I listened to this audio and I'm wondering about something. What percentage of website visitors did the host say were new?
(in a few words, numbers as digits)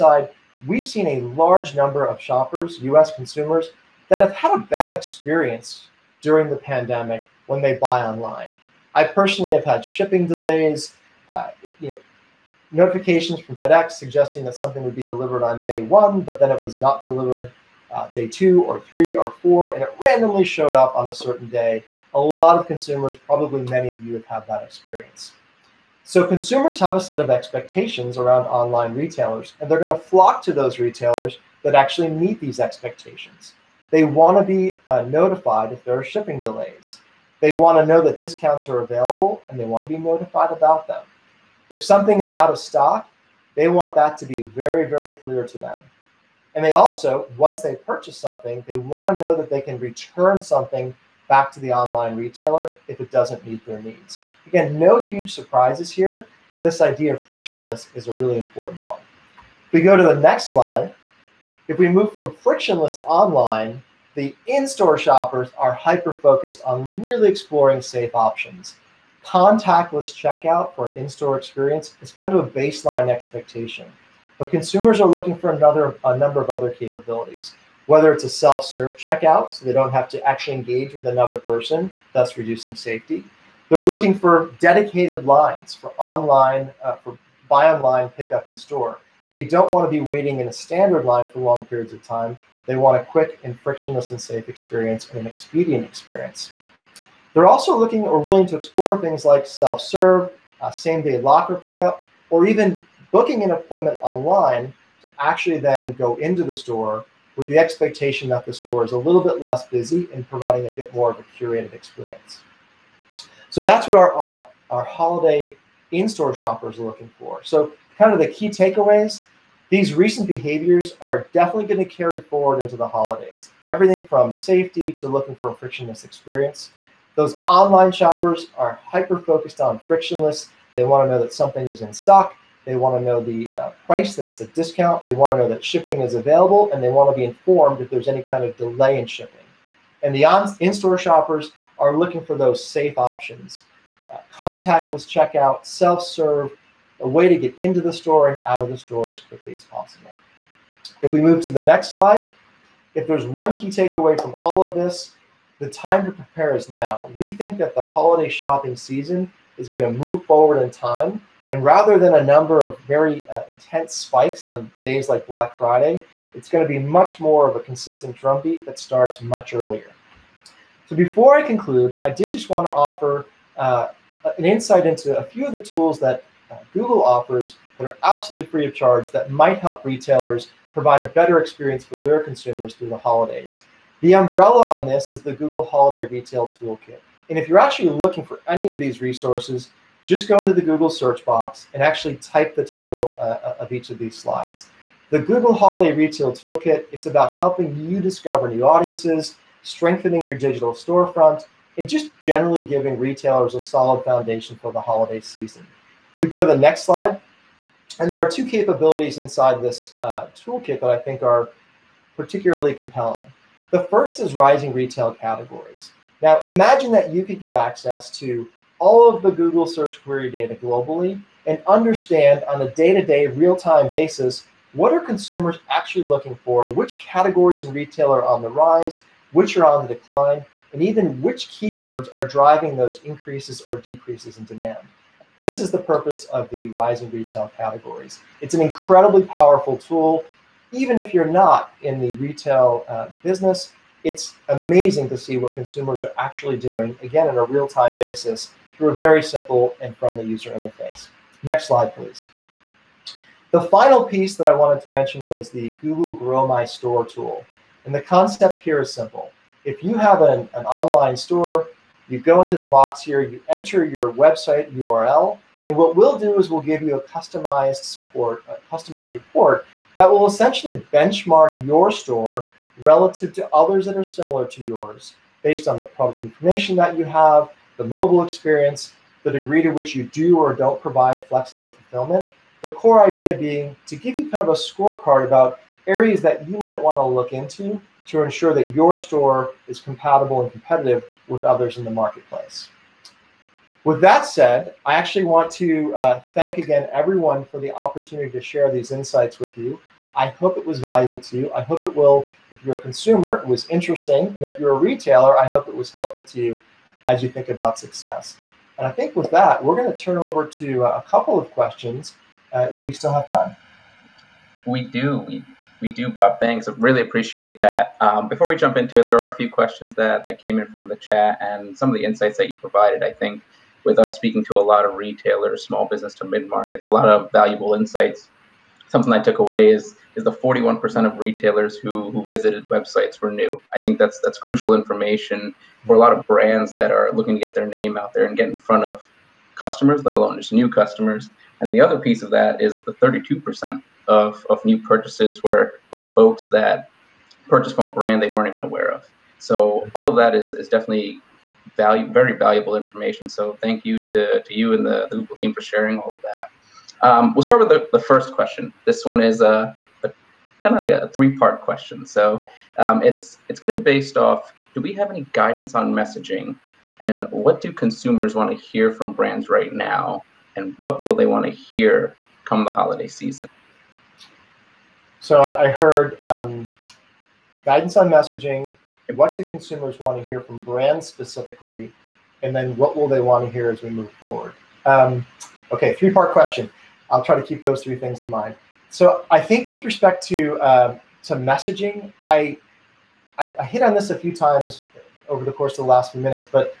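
41%.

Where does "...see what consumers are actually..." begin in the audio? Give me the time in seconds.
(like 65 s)
245 s.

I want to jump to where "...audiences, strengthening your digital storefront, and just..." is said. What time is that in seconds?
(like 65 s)
198 s.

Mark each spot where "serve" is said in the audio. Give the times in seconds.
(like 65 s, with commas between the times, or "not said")
78 s, 99 s, 145 s.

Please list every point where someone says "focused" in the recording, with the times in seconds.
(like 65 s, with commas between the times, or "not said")
65 s, 128 s.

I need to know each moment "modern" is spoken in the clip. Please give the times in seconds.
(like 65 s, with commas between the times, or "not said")
not said.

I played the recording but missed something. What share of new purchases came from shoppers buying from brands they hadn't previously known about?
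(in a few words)
32%.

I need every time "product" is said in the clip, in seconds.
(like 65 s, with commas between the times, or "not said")
275 s.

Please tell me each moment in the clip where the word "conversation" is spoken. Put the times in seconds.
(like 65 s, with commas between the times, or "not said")
not said.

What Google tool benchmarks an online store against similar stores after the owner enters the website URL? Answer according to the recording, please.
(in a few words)
Google Grow My Store.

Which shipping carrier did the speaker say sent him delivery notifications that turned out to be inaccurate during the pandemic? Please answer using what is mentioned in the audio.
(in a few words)
FedEx.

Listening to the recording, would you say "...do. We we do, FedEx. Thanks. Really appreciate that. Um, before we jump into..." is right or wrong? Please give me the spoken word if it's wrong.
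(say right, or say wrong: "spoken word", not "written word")
wrong: "Bob", not "FedEx".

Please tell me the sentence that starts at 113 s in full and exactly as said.
So that's what our uh, our holiday in-store shoppers are looking for.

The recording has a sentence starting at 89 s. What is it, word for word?
They don't want to be waiting in a standard line for long periods of time.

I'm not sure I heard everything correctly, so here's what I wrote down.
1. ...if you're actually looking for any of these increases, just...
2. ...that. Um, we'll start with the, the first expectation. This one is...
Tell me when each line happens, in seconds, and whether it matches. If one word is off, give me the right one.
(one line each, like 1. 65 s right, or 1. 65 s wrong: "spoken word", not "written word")
1. 187 s wrong: "resources", not "increases"
2. 356 s wrong: "question", not "expectation".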